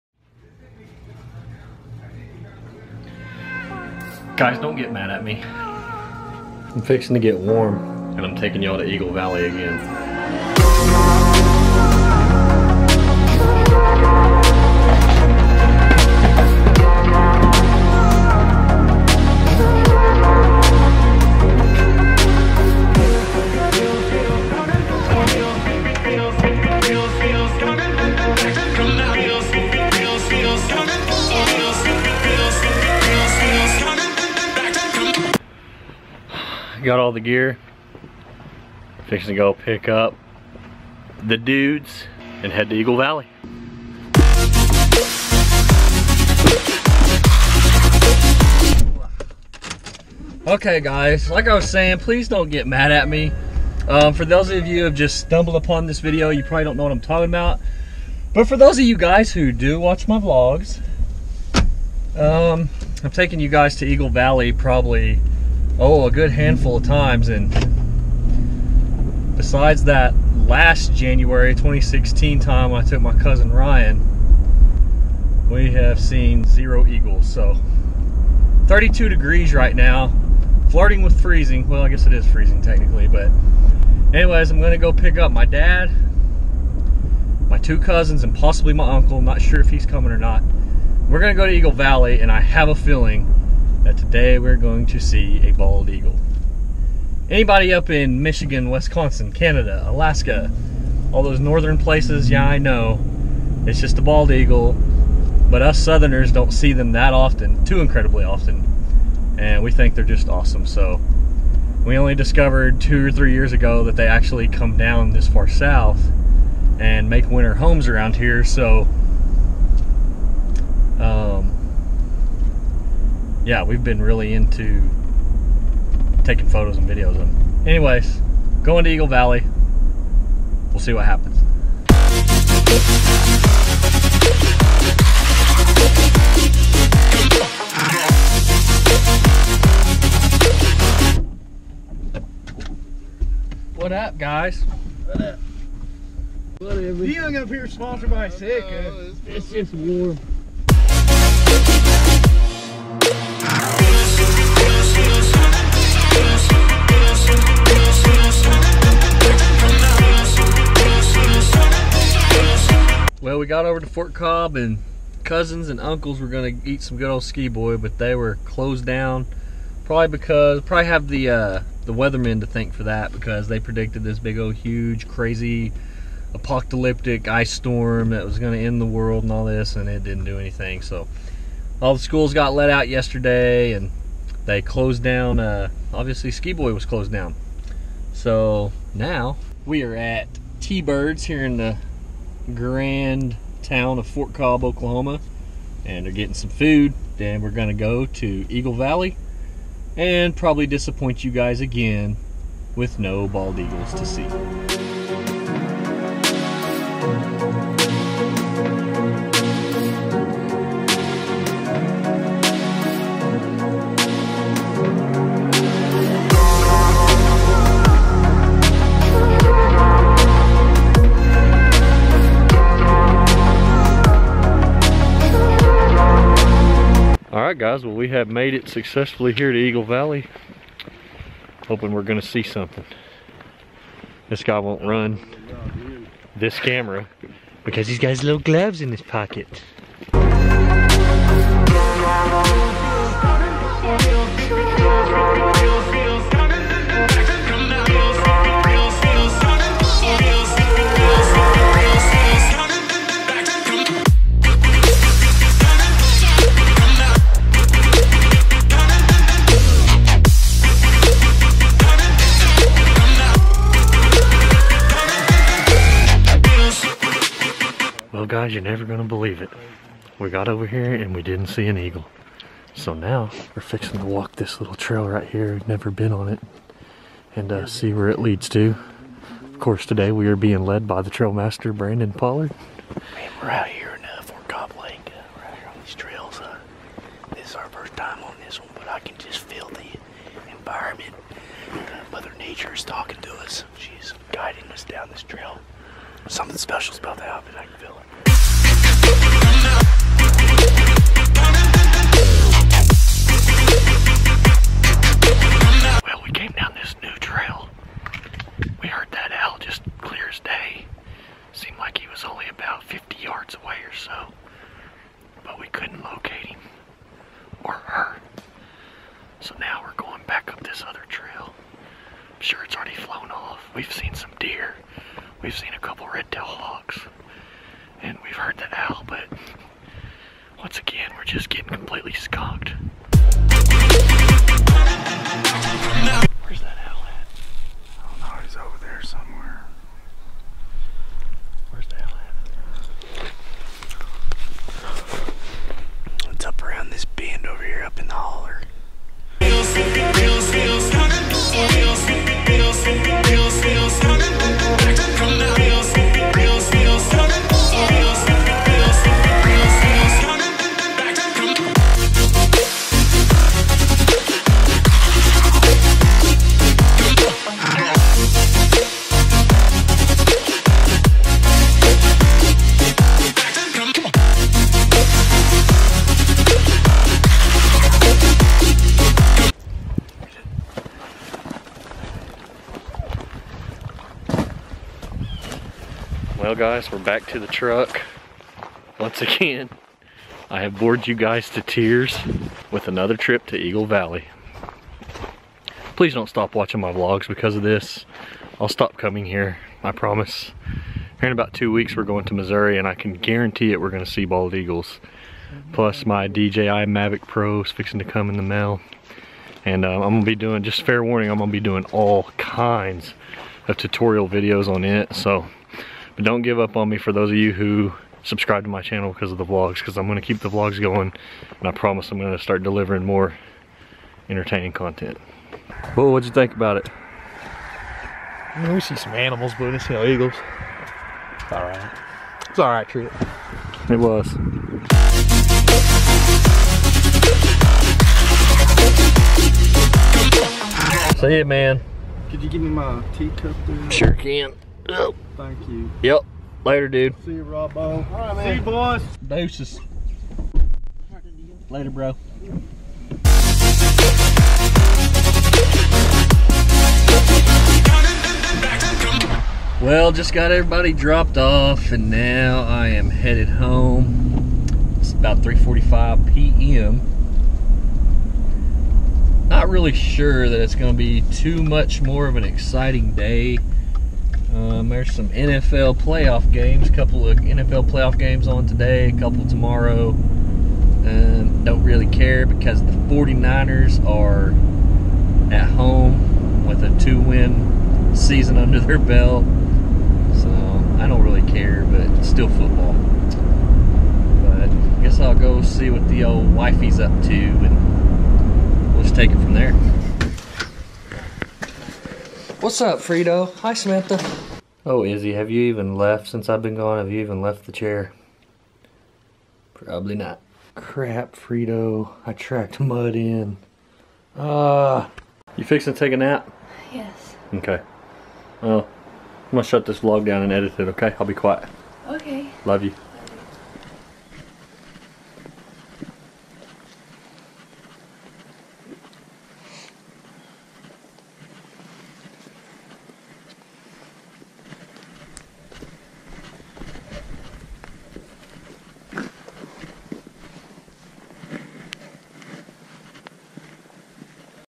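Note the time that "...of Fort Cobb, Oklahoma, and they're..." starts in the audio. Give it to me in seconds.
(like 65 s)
193 s.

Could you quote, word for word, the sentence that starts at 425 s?
Well, what'd you think about it?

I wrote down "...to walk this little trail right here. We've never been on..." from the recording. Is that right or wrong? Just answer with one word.
right.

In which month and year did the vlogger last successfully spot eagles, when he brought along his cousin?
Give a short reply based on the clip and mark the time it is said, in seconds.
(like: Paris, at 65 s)
January 2016, at 70 s.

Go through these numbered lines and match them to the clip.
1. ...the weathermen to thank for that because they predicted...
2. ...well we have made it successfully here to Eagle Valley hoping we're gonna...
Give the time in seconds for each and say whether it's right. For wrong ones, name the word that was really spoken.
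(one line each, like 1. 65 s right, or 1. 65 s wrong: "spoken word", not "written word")
1. 171 s right
2. 227 s right.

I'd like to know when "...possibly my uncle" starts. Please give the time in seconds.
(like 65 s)
88 s.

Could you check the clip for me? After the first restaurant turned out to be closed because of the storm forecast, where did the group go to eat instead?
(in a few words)
T Birds.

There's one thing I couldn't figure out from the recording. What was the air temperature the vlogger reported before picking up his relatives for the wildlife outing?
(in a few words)
32 degrees.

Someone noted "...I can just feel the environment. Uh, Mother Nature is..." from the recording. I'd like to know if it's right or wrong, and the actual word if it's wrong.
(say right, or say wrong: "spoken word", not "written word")
right.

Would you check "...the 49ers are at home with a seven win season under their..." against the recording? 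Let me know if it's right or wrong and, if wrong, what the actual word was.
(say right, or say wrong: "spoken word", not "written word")
wrong: "two", not "seven".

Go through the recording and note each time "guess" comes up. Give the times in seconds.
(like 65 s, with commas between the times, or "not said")
81 s, 495 s.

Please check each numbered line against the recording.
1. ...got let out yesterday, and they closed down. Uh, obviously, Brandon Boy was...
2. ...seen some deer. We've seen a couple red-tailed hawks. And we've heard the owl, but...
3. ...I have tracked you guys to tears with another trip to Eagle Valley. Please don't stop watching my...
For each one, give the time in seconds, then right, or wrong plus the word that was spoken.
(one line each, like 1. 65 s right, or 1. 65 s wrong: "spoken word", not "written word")
1. 182 s wrong: "Ski", not "Brandon"
2. 323 s right
3. 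390 s wrong: "bored", not "tracked".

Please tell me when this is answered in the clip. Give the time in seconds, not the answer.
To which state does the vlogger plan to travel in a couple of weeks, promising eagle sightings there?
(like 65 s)
402 s.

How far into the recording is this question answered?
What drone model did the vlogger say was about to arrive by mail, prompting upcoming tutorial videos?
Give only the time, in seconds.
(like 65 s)
406 s.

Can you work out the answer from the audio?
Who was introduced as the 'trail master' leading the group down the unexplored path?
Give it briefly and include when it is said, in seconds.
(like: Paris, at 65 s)
Brandon Pollard, at 281 s.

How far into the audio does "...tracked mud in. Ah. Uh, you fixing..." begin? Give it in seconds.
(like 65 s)
512 s.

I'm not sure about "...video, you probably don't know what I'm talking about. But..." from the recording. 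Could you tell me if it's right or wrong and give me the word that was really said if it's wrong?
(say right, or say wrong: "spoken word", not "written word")
right.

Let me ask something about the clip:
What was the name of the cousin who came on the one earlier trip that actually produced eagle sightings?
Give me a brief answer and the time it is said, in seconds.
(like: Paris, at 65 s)
Ryan, at 73 s.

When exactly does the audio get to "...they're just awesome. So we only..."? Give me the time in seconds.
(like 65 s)
109 s.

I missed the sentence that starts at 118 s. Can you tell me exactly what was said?
So yeah, we've been really into taking photos and videos of them.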